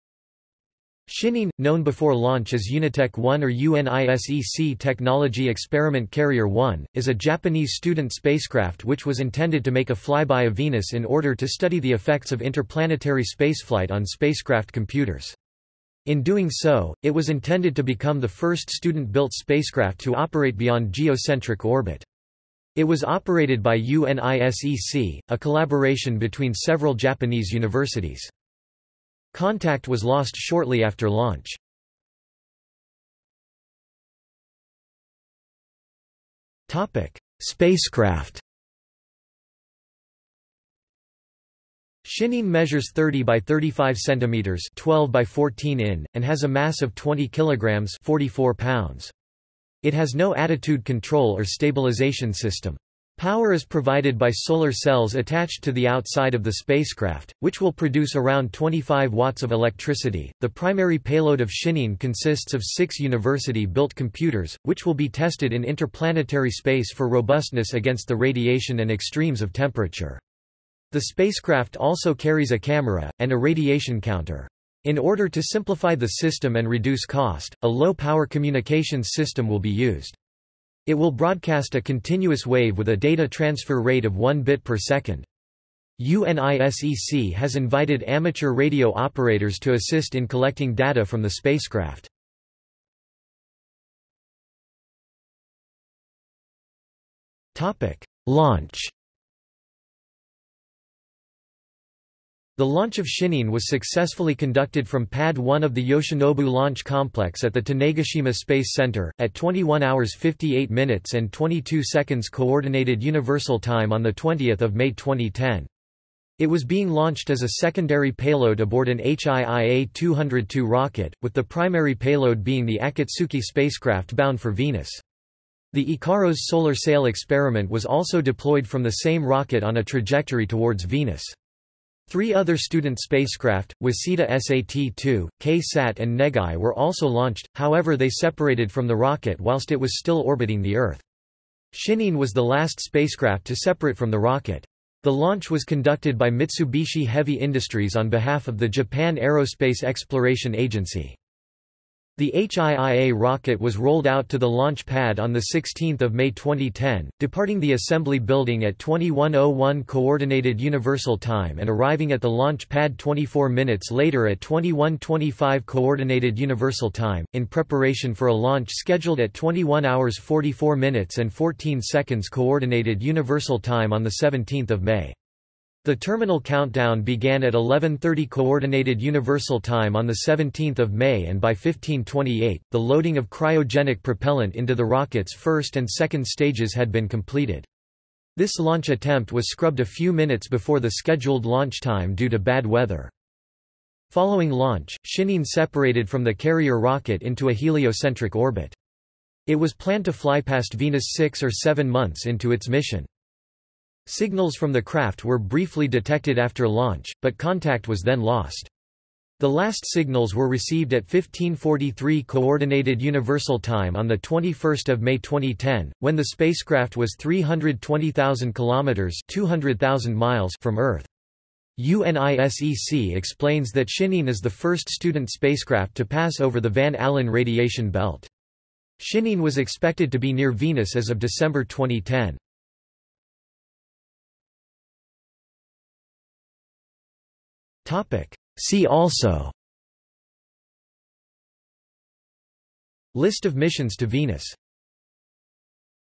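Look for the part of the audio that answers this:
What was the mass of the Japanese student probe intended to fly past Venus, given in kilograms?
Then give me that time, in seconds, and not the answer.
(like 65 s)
46 s.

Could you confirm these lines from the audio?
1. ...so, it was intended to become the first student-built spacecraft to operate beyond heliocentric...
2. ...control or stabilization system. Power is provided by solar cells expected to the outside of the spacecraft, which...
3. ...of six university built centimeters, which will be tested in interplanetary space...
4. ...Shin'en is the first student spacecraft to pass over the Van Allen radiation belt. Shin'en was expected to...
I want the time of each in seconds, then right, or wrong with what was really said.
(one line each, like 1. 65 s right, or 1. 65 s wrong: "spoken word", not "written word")
1. 16 s wrong: "geocentric", not "heliocentric"
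2. 50 s wrong: "attached", not "expected"
3. 62 s wrong: "computers", not "centimeters"
4. 223 s right.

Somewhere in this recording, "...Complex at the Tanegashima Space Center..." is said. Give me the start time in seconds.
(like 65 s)
106 s.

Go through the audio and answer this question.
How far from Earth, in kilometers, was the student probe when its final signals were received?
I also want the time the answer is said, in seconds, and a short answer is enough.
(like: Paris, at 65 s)
320,000 kilometers, at 217 s.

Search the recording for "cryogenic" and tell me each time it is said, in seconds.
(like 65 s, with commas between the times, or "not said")
183 s.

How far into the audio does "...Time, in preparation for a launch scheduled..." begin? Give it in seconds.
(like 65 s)
166 s.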